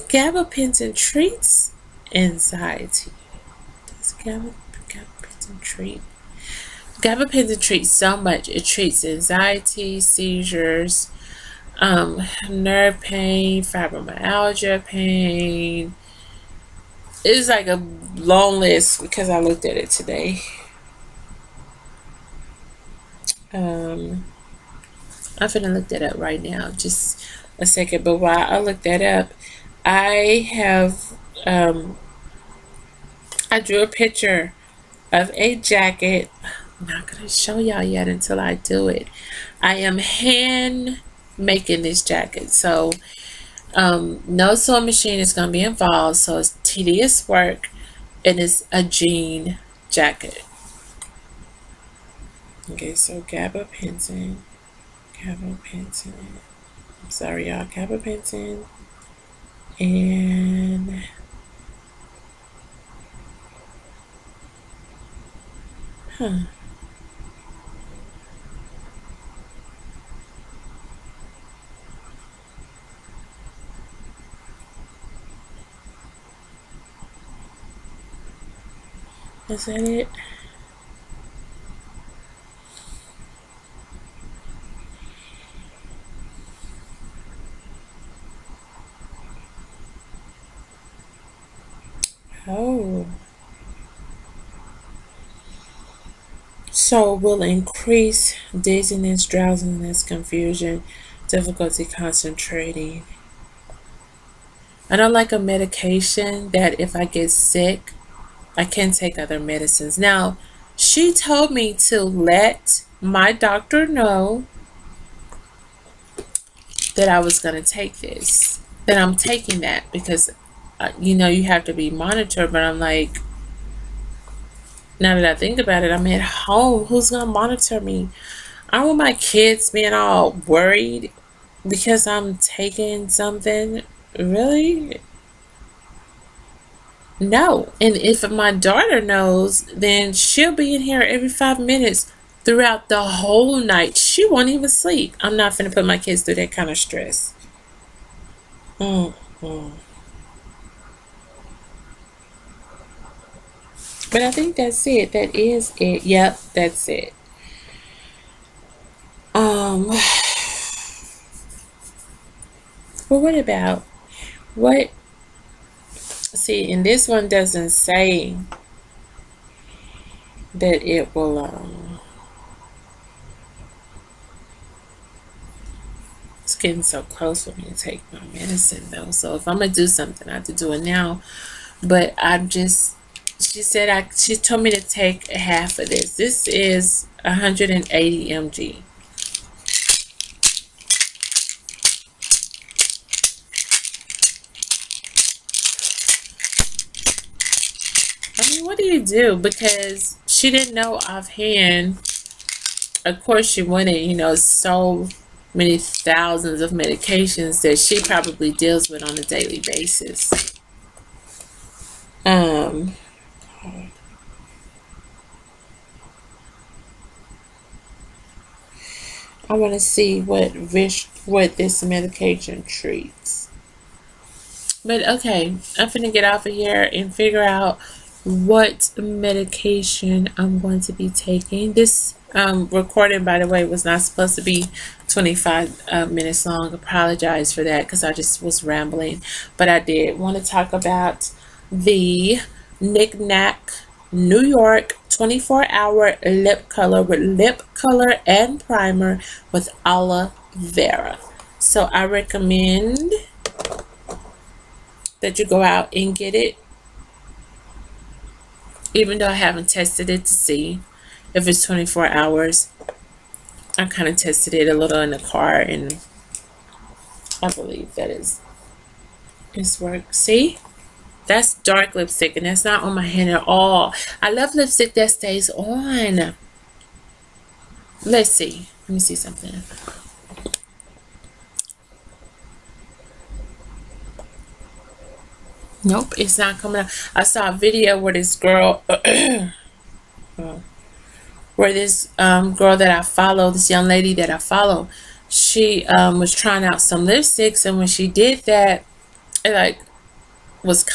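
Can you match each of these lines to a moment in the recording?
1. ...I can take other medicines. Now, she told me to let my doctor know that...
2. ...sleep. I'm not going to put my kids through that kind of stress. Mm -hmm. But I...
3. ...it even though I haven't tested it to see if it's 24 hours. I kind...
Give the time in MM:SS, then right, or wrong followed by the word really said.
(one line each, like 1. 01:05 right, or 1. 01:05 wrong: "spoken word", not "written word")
1. 01:48 right
2. 02:24 right
3. 04:16 right.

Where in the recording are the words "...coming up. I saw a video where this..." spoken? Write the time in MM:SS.
04:46.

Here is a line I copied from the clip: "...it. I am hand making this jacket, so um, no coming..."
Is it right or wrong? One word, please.
wrong.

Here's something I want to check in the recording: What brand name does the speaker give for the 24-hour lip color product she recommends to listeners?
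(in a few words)
Knick Knack New York.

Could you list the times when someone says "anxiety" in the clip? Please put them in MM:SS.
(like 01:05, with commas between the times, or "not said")
00:02, 00:09.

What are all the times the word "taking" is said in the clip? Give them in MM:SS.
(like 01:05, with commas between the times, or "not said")
01:59, 02:12, 03:51.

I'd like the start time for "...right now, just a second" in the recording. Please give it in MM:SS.
00:26.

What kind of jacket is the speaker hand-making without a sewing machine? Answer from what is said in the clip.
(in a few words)
jean jacket.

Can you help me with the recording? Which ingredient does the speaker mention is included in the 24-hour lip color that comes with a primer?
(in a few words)
aloe vera.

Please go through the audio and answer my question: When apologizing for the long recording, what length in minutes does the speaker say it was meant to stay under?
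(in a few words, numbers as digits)
25.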